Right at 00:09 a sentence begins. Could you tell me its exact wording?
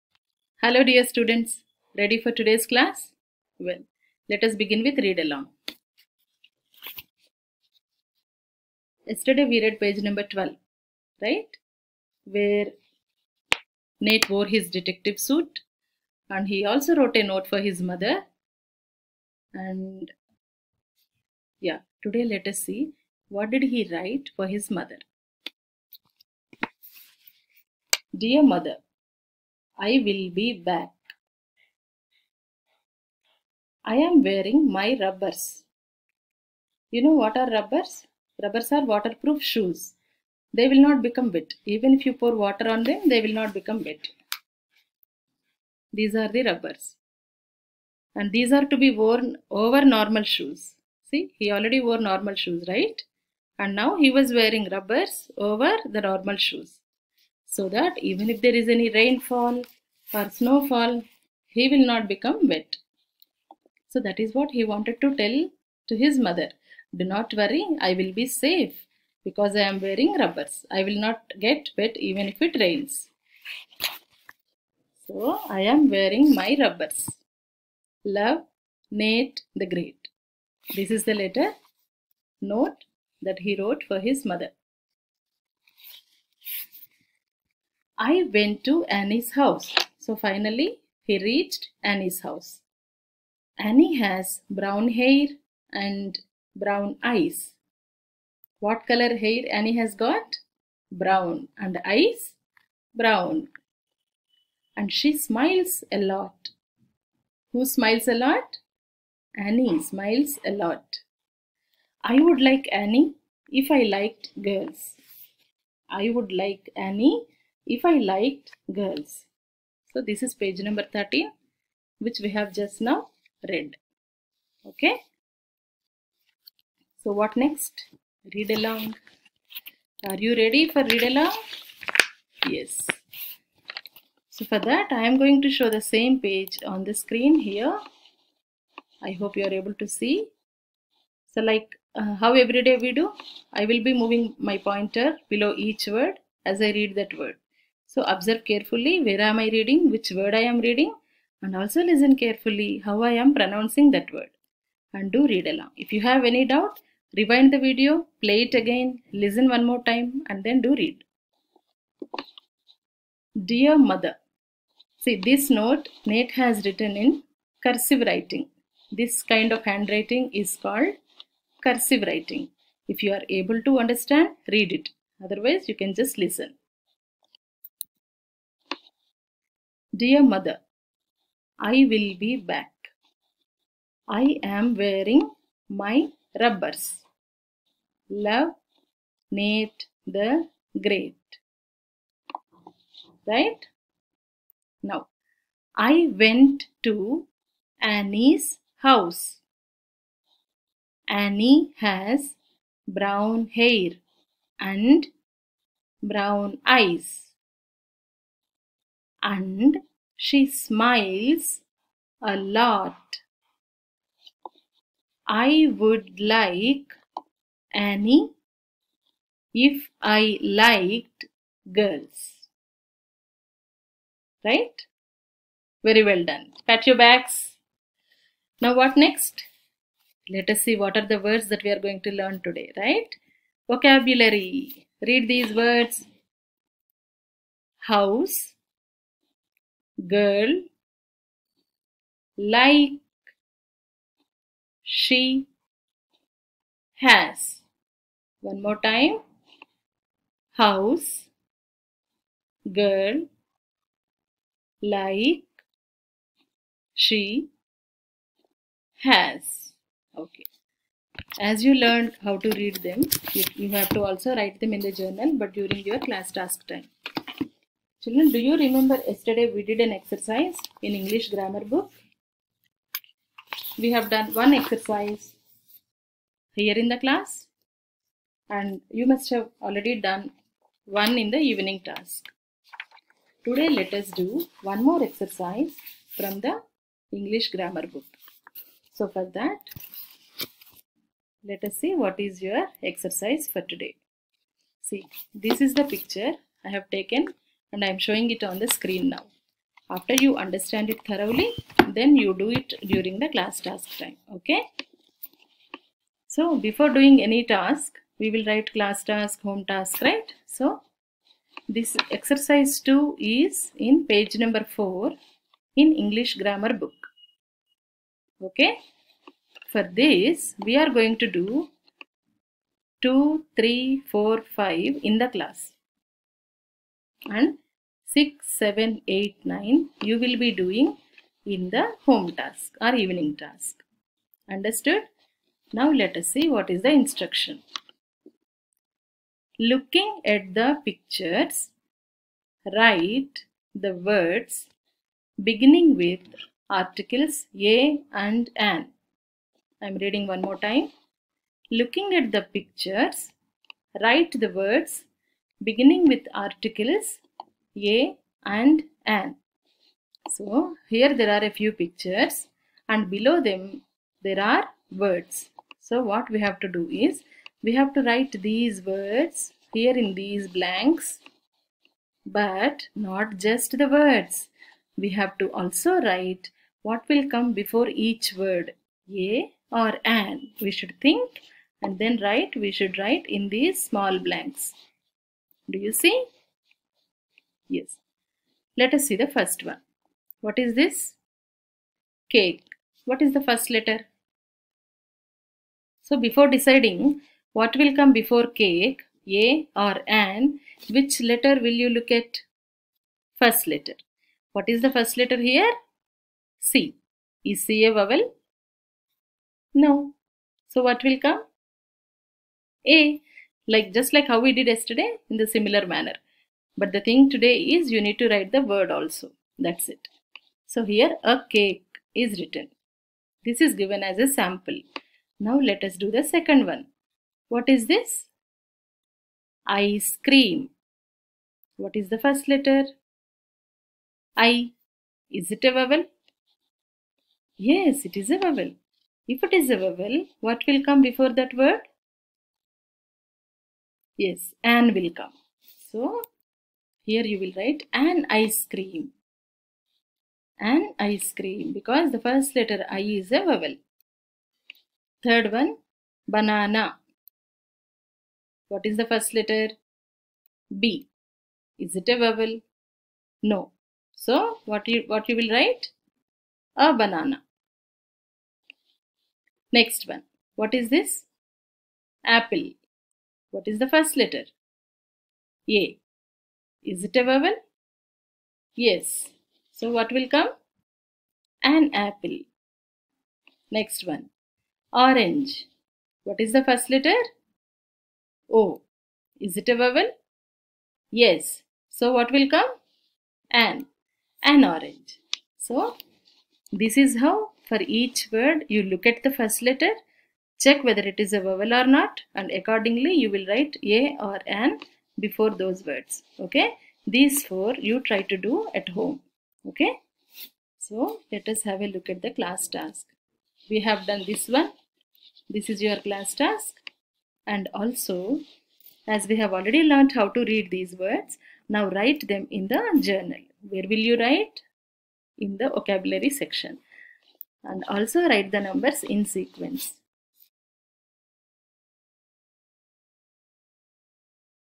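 Yesterday we read page number 12, right?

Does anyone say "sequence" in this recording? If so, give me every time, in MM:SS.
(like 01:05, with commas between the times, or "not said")
08:49.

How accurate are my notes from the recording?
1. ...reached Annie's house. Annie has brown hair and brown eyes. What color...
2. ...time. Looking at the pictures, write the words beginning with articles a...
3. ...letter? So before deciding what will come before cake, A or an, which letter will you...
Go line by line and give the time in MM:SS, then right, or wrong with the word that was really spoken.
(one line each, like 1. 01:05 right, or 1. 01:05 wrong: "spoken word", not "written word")
1. 01:31 right
2. 05:50 right
3. 06:33 right.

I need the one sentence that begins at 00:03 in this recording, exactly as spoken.
Well, let us begin with read along.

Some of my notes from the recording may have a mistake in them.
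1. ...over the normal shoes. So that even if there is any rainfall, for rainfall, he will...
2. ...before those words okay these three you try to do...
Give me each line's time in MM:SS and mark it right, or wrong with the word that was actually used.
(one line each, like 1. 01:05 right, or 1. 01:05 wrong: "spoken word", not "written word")
1. 00:55 wrong: "snowfall", not "rainfall"
2. 08:25 wrong: "four", not "three".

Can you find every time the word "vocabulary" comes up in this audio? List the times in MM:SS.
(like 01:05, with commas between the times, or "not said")
03:53, 08:45.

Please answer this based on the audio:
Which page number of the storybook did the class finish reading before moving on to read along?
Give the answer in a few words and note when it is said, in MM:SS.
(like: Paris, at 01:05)
13, at 02:00.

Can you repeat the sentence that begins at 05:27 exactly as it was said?
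And 6, 7, 8, 9 you will be doing in the home task or evening task.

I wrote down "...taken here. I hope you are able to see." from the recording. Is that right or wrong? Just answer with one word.
wrong.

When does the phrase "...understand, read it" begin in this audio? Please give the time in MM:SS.
02:53.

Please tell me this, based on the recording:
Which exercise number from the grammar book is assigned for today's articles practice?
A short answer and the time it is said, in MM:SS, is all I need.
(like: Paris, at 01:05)
exercise 2, at 05:12.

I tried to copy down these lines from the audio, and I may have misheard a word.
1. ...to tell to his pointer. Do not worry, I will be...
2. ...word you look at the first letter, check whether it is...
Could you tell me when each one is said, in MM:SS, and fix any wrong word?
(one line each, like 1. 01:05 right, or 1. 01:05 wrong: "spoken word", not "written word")
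1. 01:05 wrong: "mother", not "pointer"
2. 08:18 right.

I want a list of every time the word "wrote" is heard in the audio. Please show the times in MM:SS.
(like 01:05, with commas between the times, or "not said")
00:16, 01:23.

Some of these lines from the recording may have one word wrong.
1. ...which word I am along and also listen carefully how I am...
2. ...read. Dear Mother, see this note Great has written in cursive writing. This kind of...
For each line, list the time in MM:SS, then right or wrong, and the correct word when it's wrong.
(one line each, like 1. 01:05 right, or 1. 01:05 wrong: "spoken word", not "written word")
1. 02:29 wrong: "reading", not "along"
2. 02:40 wrong: "Nate", not "Great".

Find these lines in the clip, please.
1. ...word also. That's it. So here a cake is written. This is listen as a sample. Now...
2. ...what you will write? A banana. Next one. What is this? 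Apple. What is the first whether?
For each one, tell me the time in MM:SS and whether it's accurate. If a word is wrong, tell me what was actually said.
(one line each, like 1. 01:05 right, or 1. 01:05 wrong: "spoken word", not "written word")
1. 06:58 wrong: "given", not "listen"
2. 07:45 wrong: "letter", not "whether".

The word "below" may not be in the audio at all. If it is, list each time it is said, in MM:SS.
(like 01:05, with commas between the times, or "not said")
02:25, 06:03.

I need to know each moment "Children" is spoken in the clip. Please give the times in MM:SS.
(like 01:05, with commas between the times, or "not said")
04:28.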